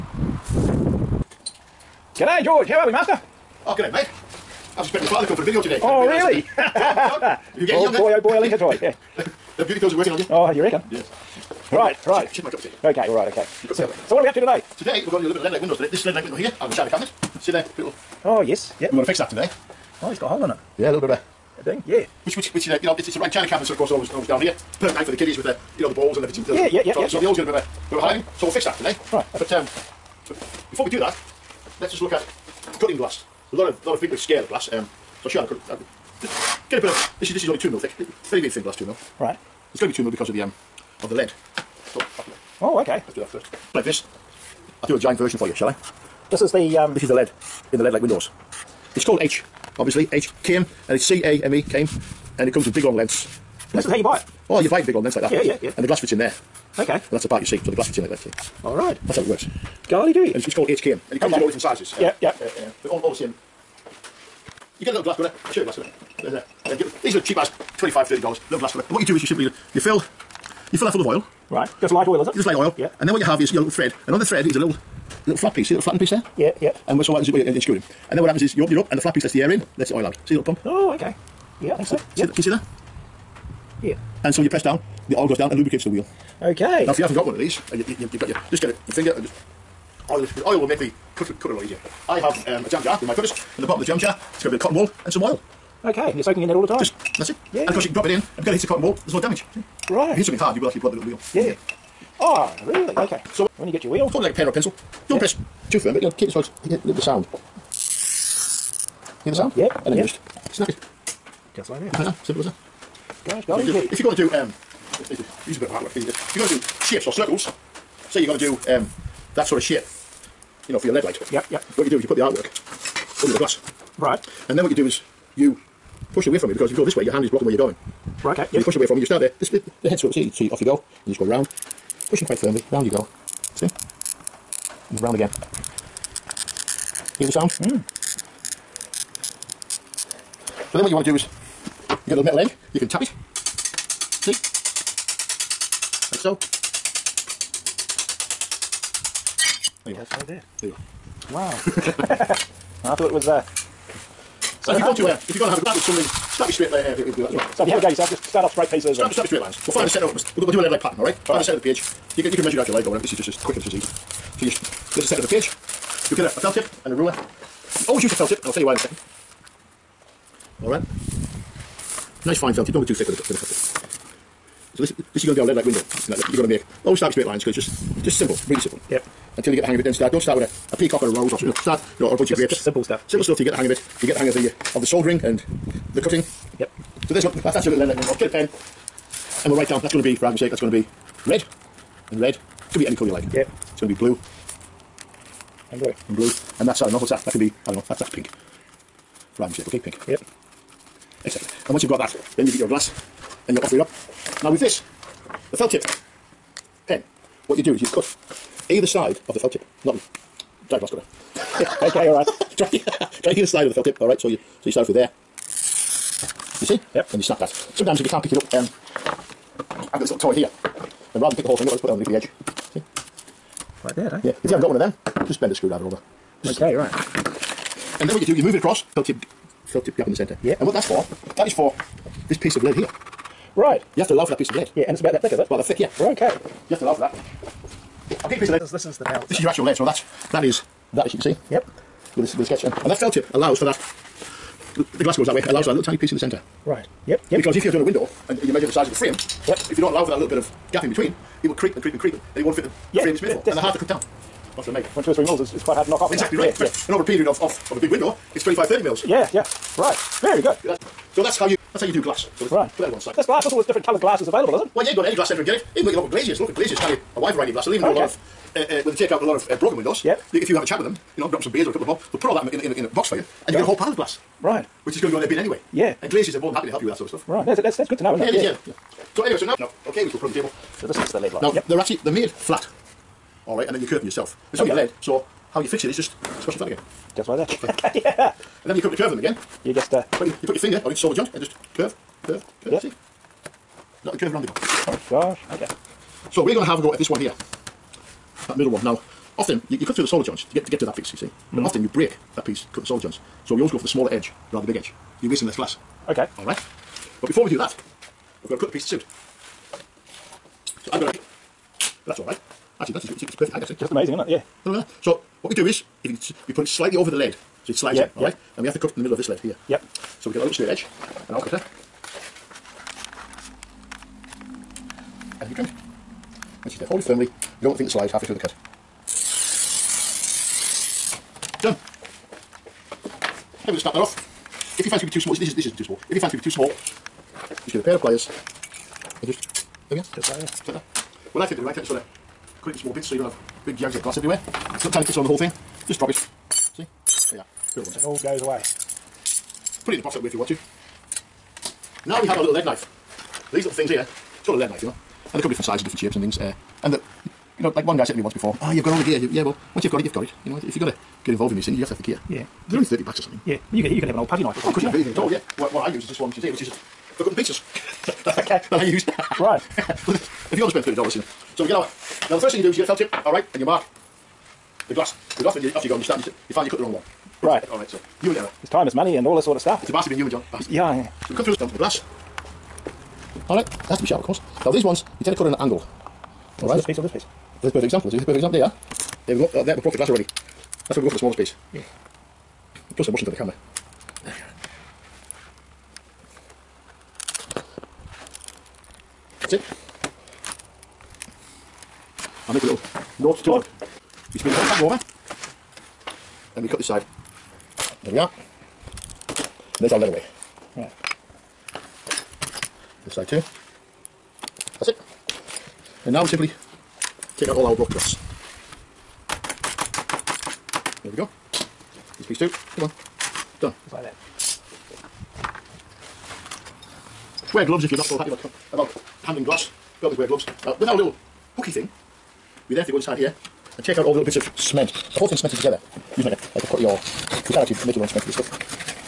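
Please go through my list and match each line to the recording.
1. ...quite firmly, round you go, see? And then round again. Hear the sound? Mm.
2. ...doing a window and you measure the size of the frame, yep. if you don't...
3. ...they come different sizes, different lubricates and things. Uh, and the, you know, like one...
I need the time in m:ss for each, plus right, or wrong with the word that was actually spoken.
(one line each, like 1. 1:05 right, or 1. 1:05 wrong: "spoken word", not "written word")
1. 2:12 right
2. 4:07 right
3. 5:55 wrong: "shapes", not "lubricates".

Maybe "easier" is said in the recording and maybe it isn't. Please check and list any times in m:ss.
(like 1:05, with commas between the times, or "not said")
1:31.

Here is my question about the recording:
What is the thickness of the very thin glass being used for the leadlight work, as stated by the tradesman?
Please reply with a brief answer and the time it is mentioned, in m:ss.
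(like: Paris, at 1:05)
2 mil, at 0:37.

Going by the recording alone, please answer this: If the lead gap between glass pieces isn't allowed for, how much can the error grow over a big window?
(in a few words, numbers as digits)
25 to 30 mils.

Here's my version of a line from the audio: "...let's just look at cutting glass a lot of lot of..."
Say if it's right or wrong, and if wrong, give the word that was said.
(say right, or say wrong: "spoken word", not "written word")
right.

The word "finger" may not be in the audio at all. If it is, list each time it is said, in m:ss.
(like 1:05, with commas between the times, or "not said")
1:28, 4:50.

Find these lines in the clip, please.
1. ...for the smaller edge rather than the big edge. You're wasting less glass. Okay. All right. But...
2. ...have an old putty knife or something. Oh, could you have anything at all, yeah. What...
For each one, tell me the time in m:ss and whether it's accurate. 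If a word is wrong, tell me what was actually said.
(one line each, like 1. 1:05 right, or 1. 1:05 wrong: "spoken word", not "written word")
1. 5:03 right
2. 6:04 right.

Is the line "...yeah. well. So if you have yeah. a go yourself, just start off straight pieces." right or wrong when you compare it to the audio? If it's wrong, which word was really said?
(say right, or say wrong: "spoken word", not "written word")
right.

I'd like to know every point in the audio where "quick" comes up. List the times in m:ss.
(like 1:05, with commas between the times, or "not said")
2:43.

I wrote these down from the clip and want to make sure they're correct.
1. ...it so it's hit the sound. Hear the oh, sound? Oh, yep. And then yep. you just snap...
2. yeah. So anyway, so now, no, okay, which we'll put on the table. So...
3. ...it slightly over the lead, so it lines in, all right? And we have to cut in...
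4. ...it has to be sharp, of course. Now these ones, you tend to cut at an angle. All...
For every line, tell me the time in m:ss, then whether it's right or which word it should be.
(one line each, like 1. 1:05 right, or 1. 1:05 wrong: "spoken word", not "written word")
1. 1:46 right
2. 4:38 right
3. 5:16 wrong: "slides", not "lines"
4. 6:23 right.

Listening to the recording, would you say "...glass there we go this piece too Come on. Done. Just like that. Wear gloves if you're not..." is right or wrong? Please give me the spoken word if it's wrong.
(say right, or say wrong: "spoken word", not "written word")
right.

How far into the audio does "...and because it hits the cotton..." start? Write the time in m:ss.
1:38.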